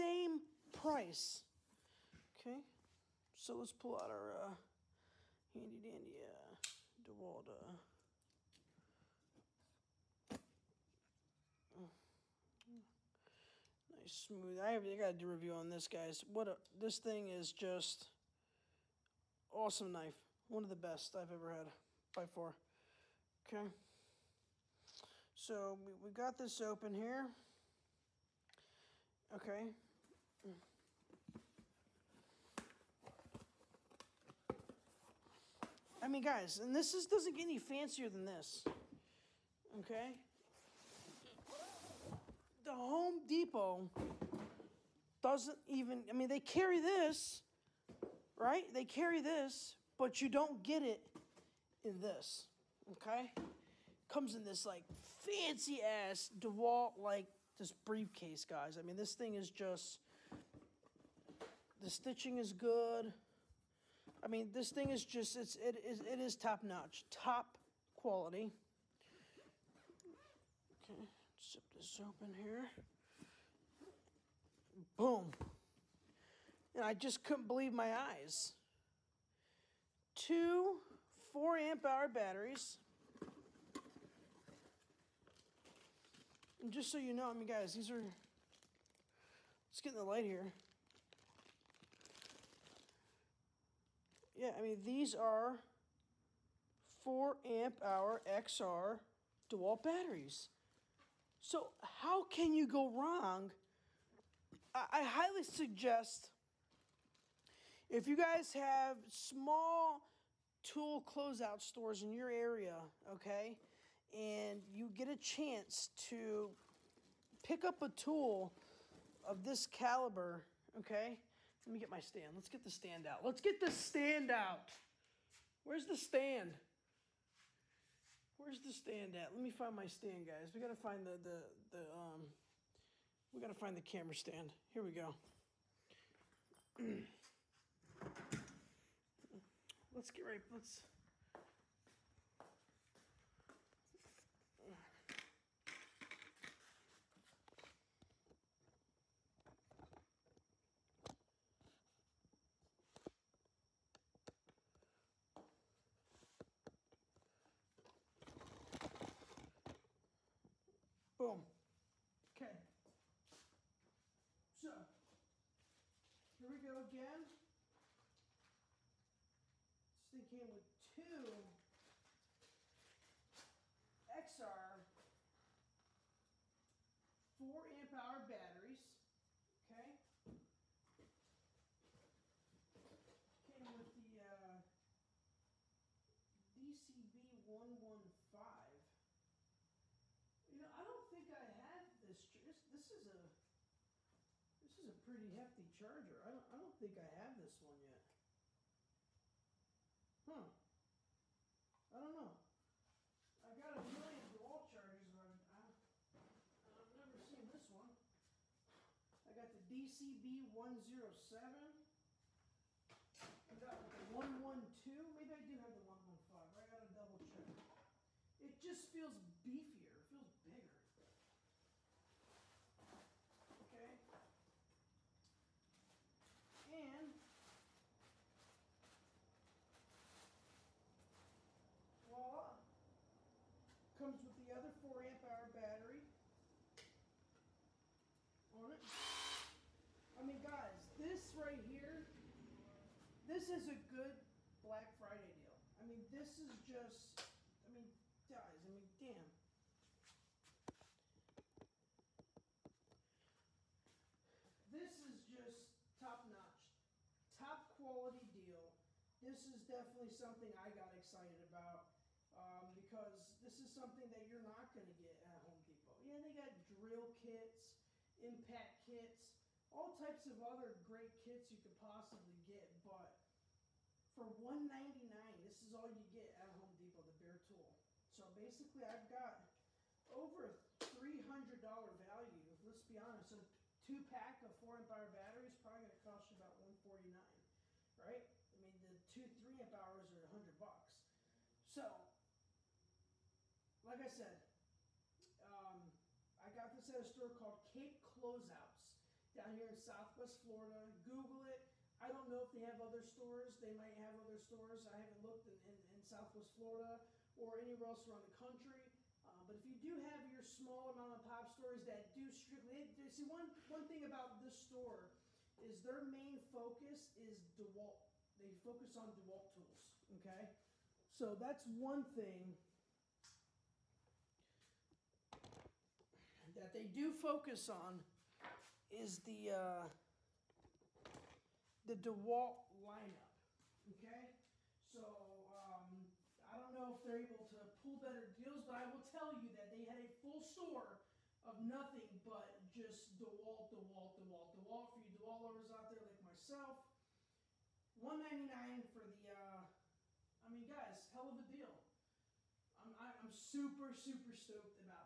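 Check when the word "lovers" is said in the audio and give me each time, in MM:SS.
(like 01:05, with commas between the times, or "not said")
05:45.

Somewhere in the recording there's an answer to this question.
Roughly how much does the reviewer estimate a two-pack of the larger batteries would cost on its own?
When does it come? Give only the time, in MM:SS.
04:46.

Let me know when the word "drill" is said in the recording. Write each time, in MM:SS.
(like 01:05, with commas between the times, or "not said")
04:26.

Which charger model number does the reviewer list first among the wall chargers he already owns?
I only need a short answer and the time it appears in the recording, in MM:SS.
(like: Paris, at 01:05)
DCB107, at 03:29.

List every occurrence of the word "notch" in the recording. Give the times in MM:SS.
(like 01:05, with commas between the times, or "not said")
01:06, 04:16.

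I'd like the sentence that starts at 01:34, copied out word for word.
yeah, I mean, these are 4 amp hour XR dual batteries.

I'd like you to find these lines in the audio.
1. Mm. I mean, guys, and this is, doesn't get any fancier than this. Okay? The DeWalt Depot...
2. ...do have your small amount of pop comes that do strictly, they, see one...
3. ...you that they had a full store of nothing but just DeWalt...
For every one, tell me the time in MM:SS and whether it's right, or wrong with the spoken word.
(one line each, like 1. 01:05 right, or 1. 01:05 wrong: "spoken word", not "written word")
1. 00:30 wrong: "Home", not "DeWalt"
2. 05:09 wrong: "stores", not "comes"
3. 05:39 right.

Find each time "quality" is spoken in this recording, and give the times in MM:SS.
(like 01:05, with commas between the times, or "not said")
01:07, 04:17.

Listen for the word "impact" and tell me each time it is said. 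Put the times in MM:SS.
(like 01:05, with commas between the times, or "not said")
04:28.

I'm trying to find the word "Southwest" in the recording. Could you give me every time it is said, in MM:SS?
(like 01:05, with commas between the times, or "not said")
04:59, 05:06.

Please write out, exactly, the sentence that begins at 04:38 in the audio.
So basically I've got over $300 value.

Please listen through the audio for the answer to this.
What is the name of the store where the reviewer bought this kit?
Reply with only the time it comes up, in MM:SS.
04:57.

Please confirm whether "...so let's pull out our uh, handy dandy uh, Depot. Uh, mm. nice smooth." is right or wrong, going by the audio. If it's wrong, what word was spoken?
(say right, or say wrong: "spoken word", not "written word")
wrong: "DeWalt", not "Depot".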